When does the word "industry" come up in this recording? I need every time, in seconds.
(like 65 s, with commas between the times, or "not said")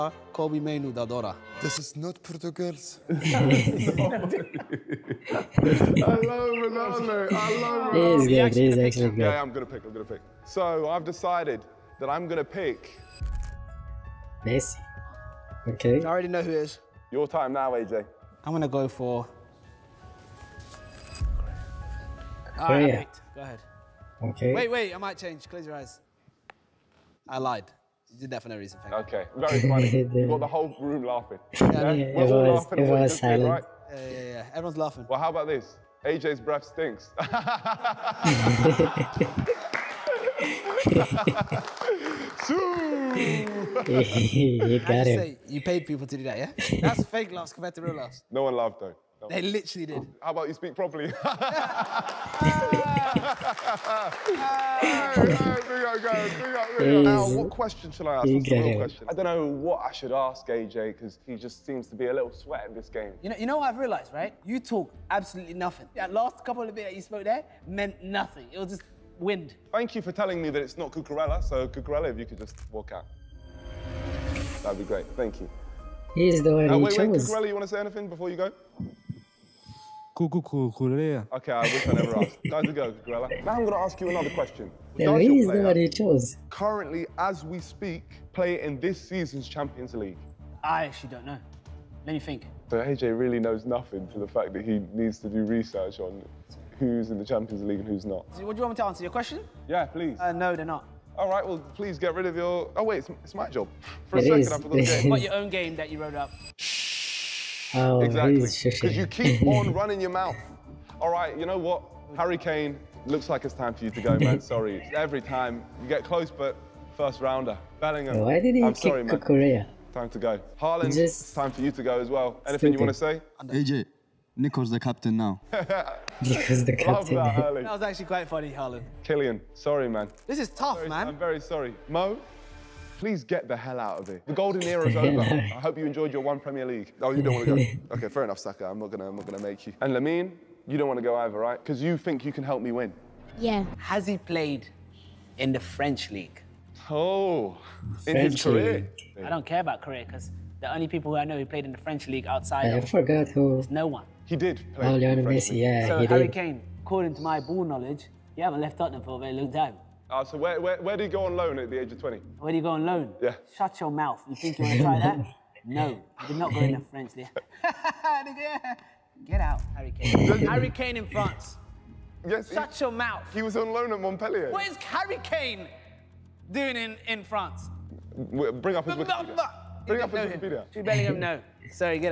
not said.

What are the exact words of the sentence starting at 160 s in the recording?
Uh, so where, where, where do you go on loan at the age of 20?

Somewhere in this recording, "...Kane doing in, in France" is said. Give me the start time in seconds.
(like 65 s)
175 s.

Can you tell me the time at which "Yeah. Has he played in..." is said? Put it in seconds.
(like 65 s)
143 s.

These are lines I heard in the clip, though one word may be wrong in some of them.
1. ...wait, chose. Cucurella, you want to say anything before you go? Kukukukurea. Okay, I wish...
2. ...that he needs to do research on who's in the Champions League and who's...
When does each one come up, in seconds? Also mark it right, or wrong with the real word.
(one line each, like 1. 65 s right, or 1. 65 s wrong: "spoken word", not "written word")
1. 76 s right
2. 94 s right.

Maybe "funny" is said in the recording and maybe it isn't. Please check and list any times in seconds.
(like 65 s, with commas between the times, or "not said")
29 s, 128 s.